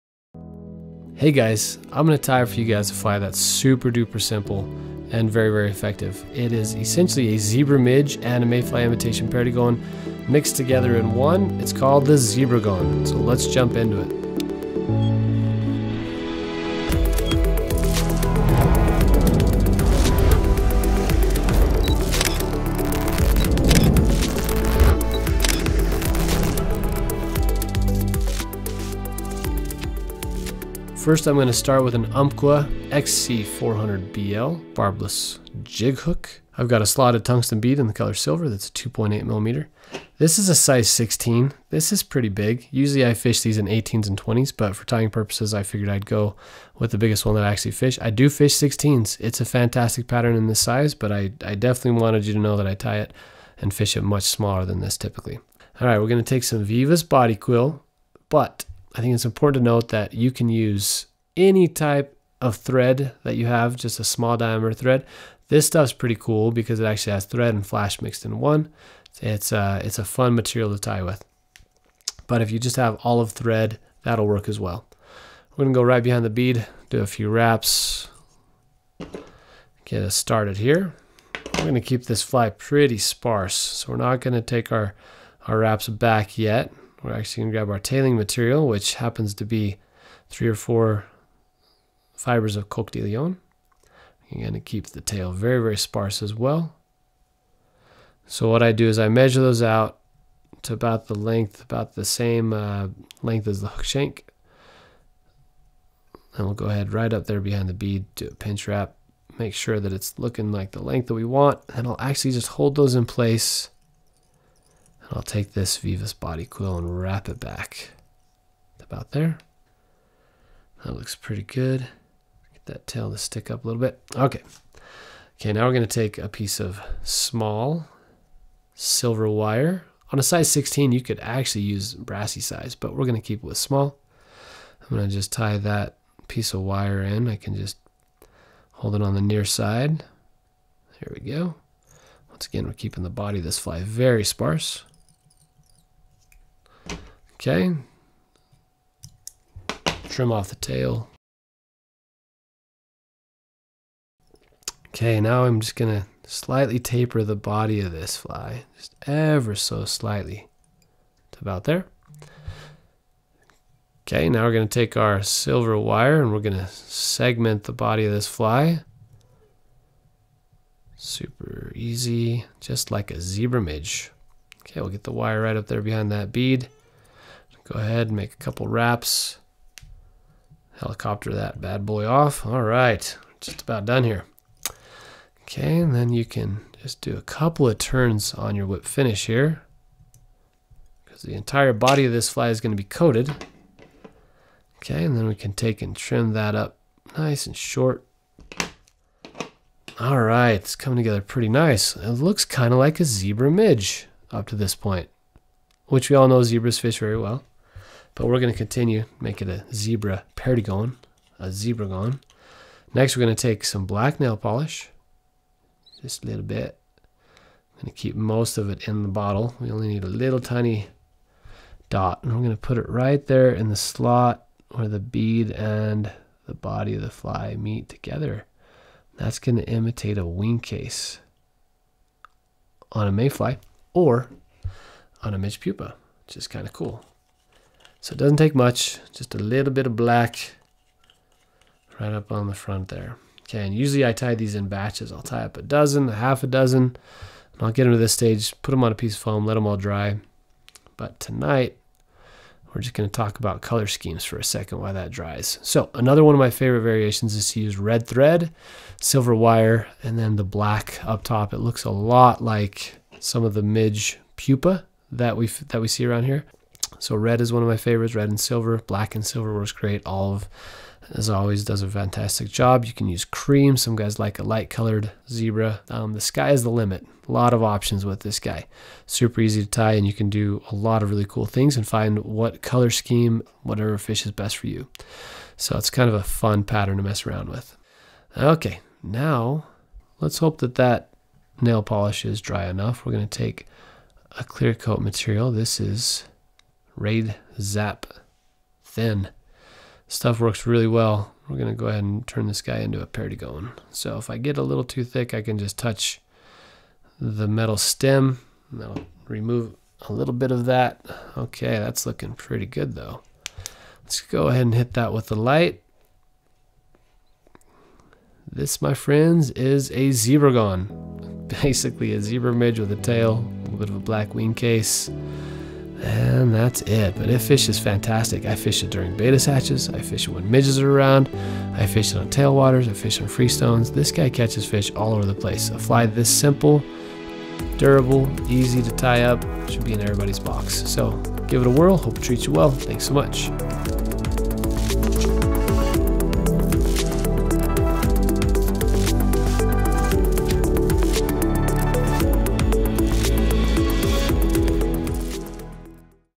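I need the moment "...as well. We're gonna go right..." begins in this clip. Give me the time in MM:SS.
01:14.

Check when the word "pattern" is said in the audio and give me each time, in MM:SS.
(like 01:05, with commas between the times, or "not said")
00:50, 04:46.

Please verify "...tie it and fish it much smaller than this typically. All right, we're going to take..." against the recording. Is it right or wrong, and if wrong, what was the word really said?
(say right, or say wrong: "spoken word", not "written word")
right.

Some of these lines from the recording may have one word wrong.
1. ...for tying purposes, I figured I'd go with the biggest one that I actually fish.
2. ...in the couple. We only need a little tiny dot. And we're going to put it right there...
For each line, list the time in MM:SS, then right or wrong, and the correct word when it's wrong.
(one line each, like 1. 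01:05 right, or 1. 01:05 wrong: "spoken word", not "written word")
1. 00:44 right
2. 03:38 wrong: "bottle", not "couple".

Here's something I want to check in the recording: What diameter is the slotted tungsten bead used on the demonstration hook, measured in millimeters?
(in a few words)
2.8 millimeters.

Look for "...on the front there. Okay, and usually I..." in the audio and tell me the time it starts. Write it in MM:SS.
04:02.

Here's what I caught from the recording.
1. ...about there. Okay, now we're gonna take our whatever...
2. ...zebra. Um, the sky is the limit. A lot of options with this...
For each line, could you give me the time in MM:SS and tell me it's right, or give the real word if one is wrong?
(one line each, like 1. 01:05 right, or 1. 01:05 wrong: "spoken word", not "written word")
1. 02:41 wrong: "silver", not "whatever"
2. 04:35 right.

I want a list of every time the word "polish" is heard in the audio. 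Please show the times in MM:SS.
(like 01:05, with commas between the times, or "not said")
03:34, 04:51.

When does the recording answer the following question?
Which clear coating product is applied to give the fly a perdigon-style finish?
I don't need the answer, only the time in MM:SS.
04:56.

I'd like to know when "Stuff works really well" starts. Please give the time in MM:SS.
05:00.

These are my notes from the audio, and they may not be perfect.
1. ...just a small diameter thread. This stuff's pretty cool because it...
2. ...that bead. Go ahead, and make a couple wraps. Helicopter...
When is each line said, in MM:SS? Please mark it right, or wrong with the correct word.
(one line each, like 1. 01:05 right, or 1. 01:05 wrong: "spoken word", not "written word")
1. 01:03 right
2. 02:56 right.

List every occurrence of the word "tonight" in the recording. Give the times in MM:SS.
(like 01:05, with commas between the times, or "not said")
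04:11.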